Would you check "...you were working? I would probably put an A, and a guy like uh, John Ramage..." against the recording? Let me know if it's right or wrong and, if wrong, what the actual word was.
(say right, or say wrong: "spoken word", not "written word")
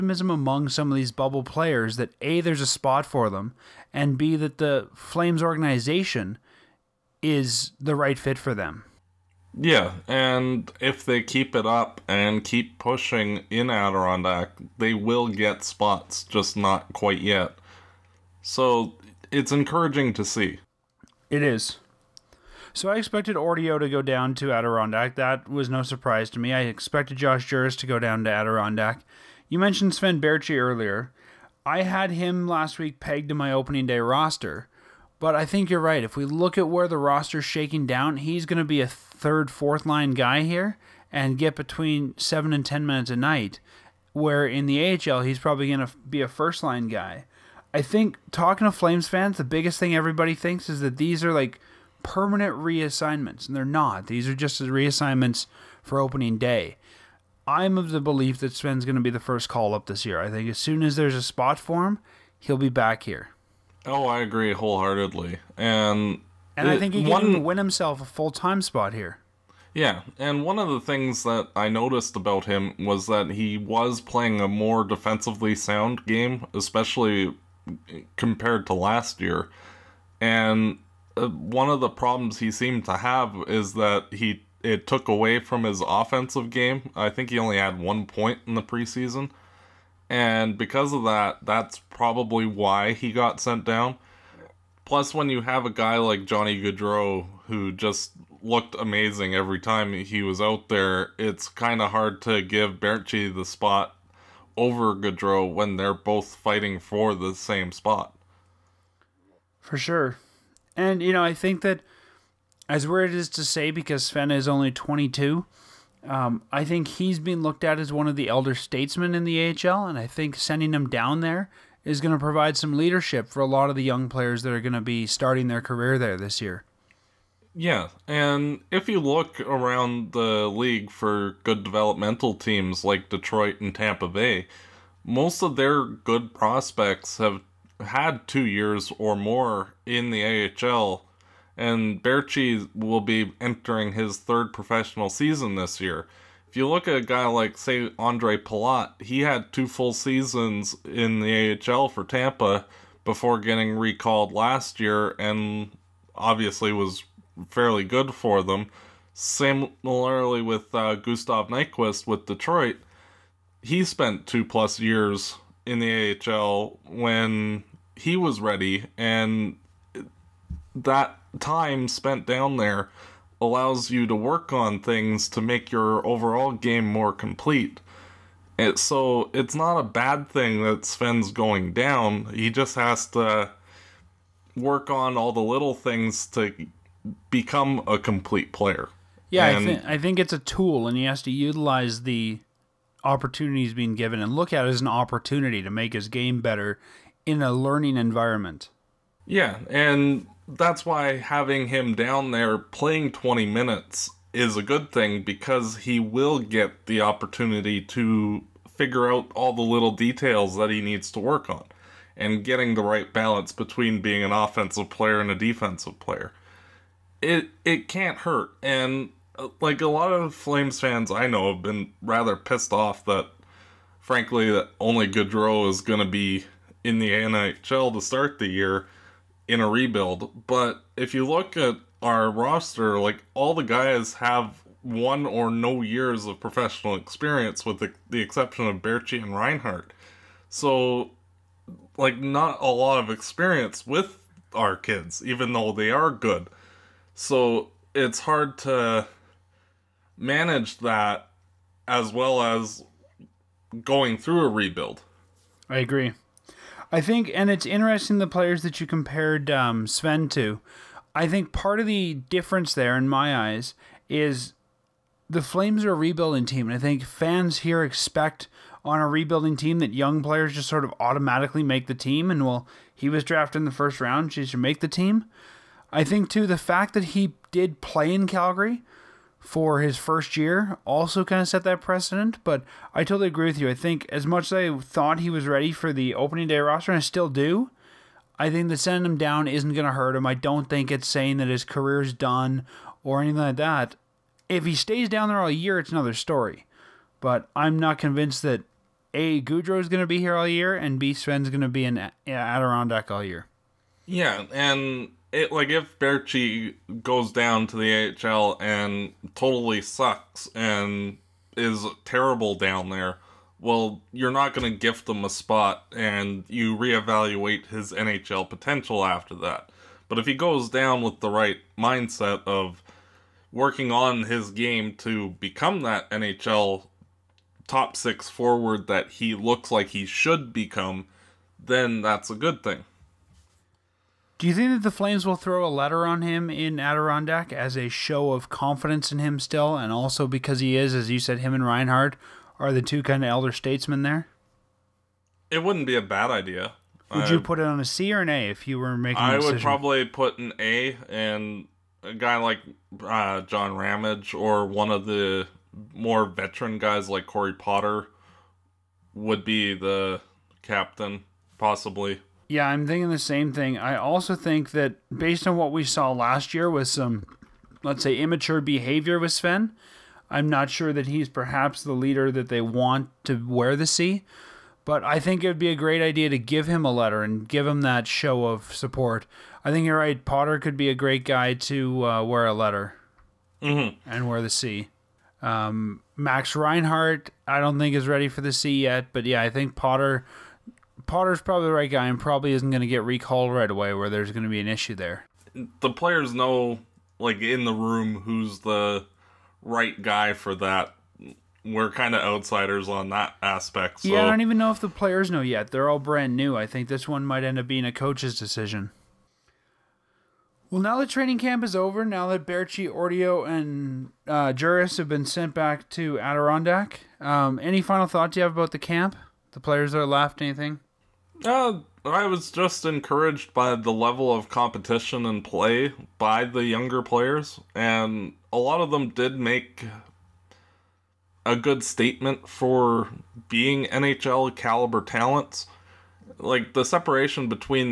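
wrong: "making", not "working".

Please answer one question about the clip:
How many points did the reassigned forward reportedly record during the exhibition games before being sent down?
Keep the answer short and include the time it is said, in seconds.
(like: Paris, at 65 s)
1, at 87 s.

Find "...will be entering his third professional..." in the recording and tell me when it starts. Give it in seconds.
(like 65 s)
142 s.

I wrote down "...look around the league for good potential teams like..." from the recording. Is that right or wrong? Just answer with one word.
wrong.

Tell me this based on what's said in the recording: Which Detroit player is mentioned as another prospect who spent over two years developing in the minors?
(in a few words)
Gustav Nyquist.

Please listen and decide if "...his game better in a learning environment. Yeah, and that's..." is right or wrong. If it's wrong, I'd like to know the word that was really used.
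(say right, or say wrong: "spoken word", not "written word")
right.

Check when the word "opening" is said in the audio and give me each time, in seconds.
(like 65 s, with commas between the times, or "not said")
33 s, 55 s, 286 s.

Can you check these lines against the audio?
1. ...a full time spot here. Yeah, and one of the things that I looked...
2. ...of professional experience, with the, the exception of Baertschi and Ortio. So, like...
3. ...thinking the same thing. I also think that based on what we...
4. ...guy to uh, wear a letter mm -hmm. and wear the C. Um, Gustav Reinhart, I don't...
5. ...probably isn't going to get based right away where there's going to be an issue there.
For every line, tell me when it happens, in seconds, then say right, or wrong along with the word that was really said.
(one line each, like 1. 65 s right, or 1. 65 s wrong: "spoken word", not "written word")
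1. 68 s wrong: "noticed", not "looked"
2. 236 s wrong: "Reinhart", not "Ortio"
3. 362 s right
4. 381 s wrong: "Max", not "Gustav"
5. 392 s wrong: "recalled", not "based".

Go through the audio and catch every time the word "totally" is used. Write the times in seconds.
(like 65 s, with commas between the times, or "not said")
283 s, 309 s.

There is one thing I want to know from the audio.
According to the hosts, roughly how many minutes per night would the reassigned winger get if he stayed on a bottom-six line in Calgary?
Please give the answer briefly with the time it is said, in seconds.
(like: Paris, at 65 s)
7 to 10, at 41 s.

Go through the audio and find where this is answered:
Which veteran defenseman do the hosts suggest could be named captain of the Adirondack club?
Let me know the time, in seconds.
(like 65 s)
357 s.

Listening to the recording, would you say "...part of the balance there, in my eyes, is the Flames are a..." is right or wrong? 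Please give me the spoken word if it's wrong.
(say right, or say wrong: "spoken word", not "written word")
wrong: "difference", not "balance".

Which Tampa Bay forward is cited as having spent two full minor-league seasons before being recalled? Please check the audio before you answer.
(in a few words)
Andre Palat.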